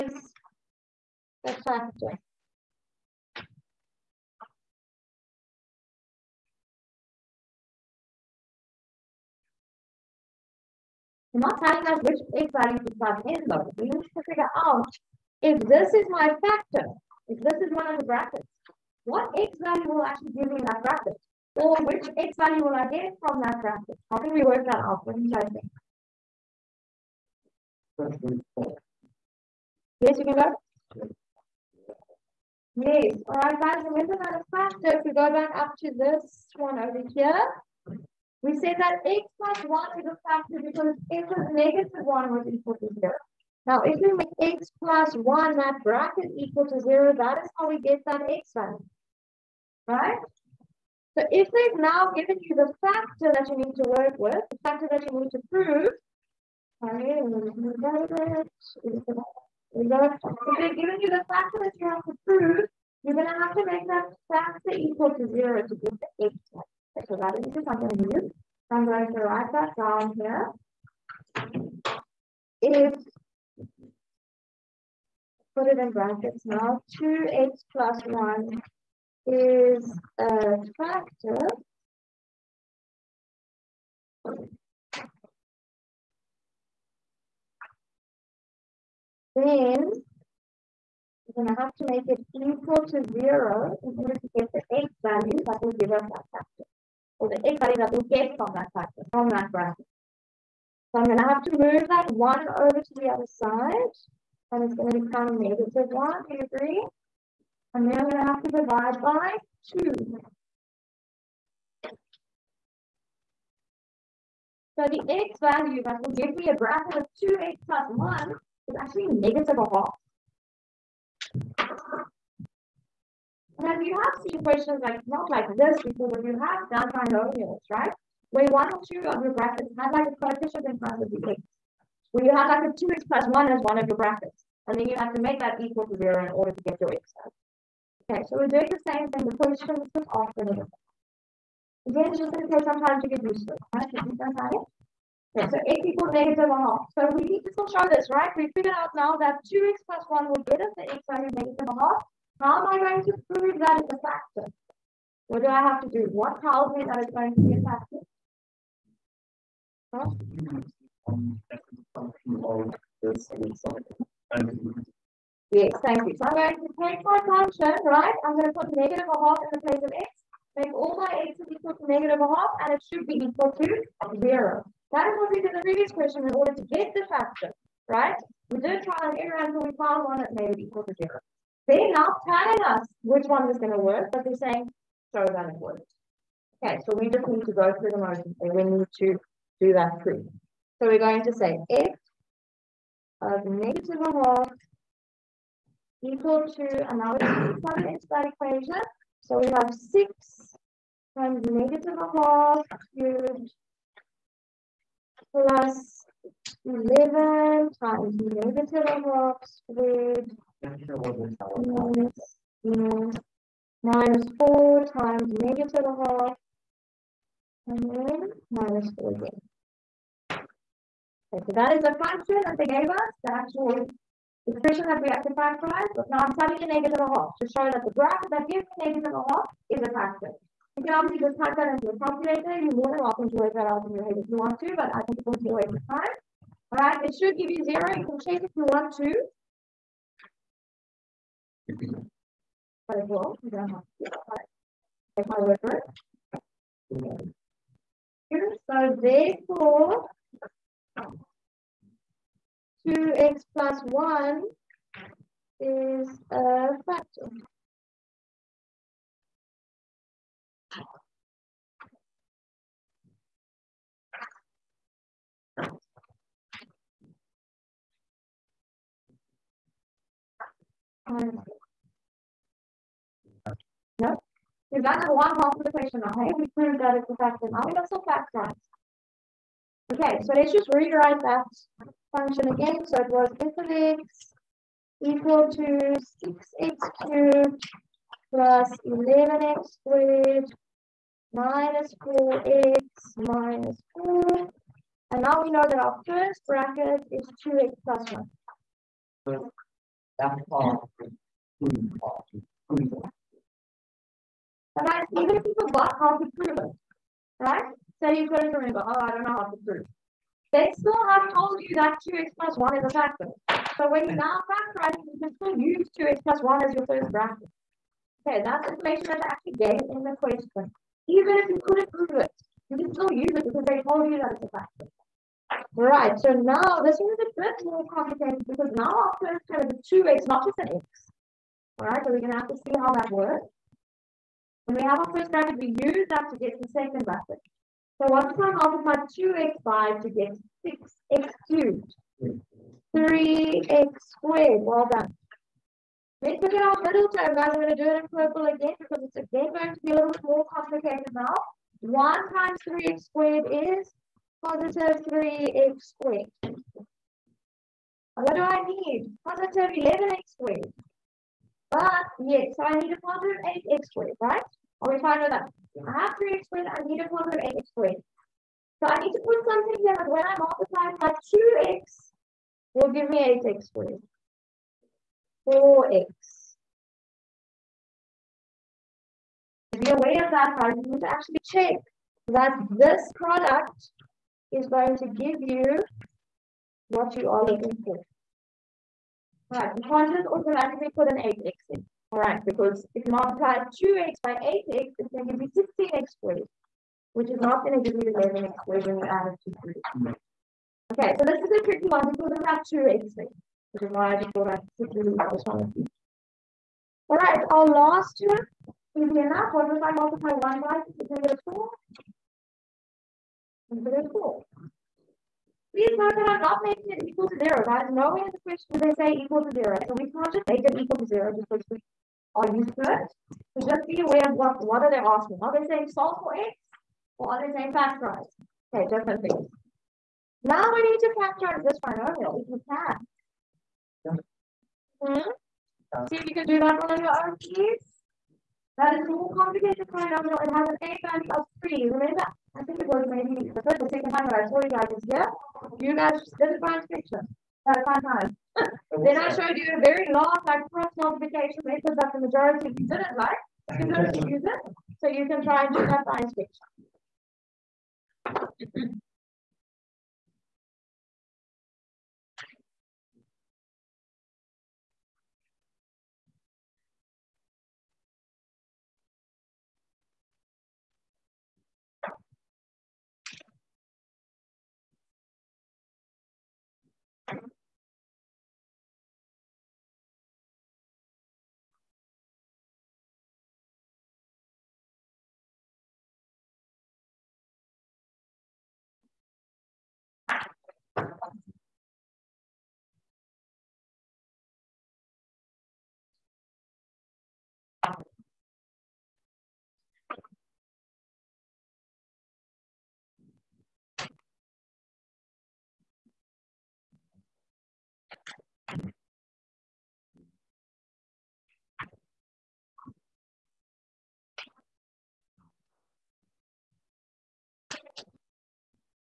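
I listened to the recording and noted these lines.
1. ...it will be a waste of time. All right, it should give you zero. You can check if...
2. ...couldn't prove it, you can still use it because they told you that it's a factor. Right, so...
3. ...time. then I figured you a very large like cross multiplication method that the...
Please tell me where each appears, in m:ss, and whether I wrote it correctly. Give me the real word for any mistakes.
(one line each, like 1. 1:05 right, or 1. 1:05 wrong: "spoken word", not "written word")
1. 3:55 right
2. 5:21 right
3. 7:27 wrong: "showed", not "figured".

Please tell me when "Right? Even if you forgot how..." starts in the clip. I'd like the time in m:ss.
5:04.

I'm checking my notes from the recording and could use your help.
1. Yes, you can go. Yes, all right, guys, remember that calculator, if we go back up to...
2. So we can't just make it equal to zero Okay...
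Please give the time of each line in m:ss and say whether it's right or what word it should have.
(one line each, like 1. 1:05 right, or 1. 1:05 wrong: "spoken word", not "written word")
1. 0:27 wrong: "factor", not "calculator"
2. 6:59 wrong: "Just", not "Okay".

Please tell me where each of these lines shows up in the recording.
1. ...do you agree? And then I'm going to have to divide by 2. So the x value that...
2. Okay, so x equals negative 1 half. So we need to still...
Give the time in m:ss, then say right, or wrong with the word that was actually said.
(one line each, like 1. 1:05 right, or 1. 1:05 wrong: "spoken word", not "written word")
1. 1:46 right
2. 2:25 right.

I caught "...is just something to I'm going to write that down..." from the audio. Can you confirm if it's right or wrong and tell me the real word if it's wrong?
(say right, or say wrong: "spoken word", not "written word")
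right.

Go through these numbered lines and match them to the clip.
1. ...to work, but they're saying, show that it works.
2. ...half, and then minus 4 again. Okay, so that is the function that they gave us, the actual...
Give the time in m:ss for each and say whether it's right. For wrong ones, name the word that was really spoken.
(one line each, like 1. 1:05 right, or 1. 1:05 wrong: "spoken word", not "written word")
1. 3:03 right
2. 3:36 right.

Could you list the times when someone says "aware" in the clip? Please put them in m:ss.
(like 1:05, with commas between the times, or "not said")
6:19, 7:04.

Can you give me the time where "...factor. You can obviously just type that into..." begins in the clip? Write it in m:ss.
3:49.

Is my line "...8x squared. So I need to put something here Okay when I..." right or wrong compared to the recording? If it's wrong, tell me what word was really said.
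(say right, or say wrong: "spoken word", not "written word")
wrong: "But", not "Okay".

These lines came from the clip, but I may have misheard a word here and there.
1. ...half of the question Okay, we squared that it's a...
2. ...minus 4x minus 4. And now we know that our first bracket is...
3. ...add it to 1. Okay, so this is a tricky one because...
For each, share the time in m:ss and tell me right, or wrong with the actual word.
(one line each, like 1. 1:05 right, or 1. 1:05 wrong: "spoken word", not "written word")
1. 4:35 wrong: "proved", not "squared"
2. 4:51 right
3. 6:39 wrong: "3", not "1".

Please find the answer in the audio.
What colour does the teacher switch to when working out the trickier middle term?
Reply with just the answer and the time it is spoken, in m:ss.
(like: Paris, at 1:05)
Purple, at 5:48.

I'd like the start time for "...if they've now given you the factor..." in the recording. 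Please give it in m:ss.
0:51.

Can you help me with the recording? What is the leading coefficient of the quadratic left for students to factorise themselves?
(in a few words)
3.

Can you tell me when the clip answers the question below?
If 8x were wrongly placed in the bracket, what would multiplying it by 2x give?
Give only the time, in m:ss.
6:35.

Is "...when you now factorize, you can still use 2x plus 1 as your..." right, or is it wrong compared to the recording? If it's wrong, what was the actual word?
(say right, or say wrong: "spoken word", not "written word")
right.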